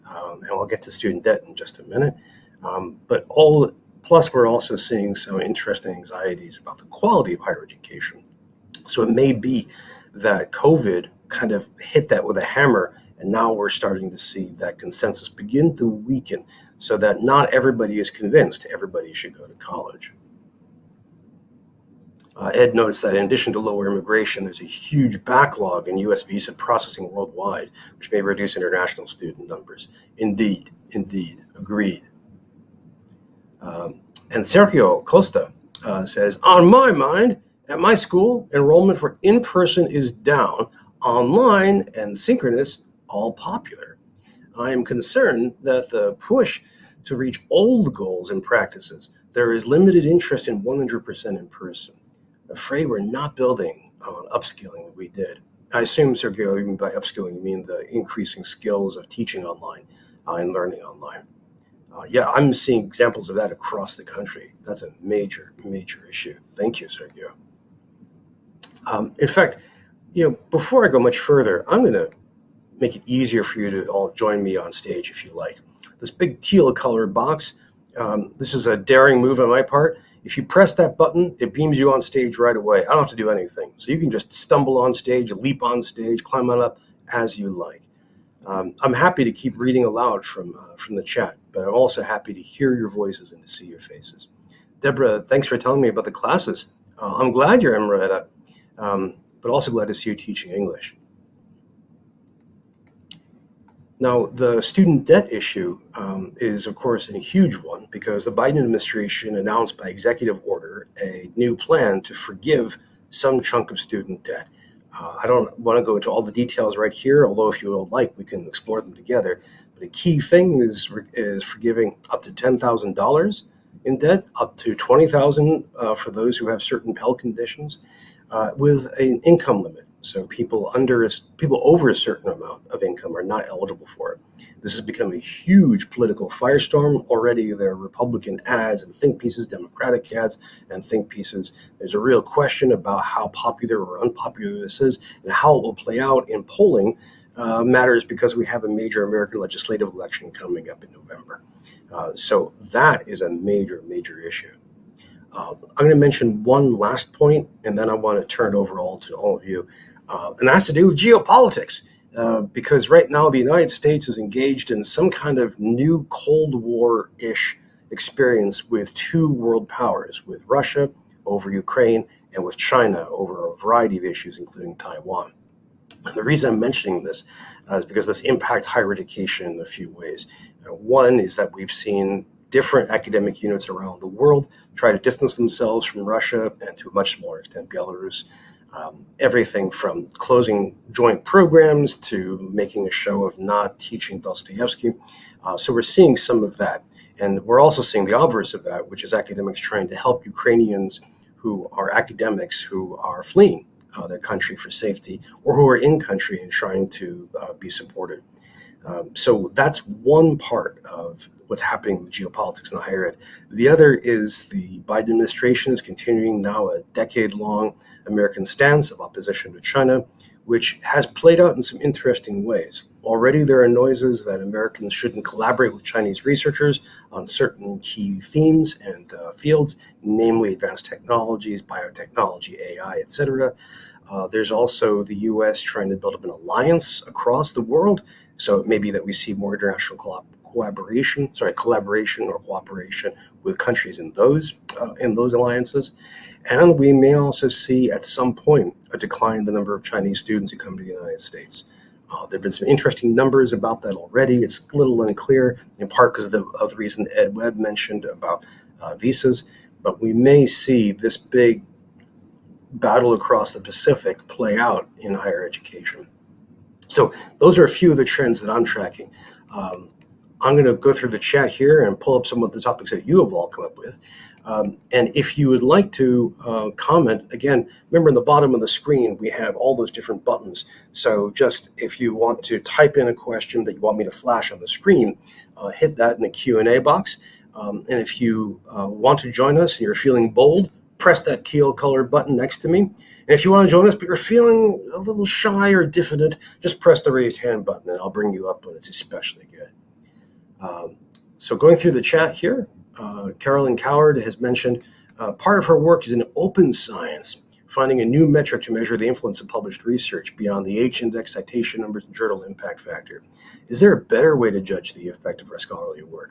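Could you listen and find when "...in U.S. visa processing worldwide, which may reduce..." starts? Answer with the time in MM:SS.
00:25.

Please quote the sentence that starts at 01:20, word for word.
If you press that button, it beams you on stage right away.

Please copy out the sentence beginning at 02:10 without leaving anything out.
So people under people over a certain amount of income are not eligible for it.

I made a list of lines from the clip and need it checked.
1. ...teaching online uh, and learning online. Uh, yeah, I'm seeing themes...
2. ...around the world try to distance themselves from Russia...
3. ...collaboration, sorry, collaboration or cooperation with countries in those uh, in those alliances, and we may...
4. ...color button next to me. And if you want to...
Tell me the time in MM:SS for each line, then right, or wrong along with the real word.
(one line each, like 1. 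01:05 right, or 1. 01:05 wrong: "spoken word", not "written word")
1. 00:59 wrong: "examples", not "themes"
2. 03:03 right
3. 04:00 right
4. 04:51 right.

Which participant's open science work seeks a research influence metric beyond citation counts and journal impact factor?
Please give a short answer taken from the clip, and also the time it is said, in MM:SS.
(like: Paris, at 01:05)
Carolyn Coward, at 05:03.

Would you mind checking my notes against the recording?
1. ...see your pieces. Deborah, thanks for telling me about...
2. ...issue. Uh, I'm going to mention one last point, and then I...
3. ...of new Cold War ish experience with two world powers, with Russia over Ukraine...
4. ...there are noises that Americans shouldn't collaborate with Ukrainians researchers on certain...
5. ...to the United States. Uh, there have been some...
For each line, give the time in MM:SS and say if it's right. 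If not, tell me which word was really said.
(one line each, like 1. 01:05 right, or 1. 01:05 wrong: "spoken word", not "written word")
1. 01:33 wrong: "faces", not "pieces"
2. 02:34 right
3. 02:45 right
4. 03:43 wrong: "Chinese", not "Ukrainians"
5. 04:10 right.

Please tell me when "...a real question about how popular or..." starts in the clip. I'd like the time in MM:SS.
02:21.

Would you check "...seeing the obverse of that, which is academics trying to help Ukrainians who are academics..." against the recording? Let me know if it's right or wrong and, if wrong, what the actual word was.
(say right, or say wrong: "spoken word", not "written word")
right.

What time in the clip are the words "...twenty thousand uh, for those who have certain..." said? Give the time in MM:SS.
02:04.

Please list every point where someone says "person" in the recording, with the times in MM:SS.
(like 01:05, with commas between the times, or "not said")
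00:39, 00:51.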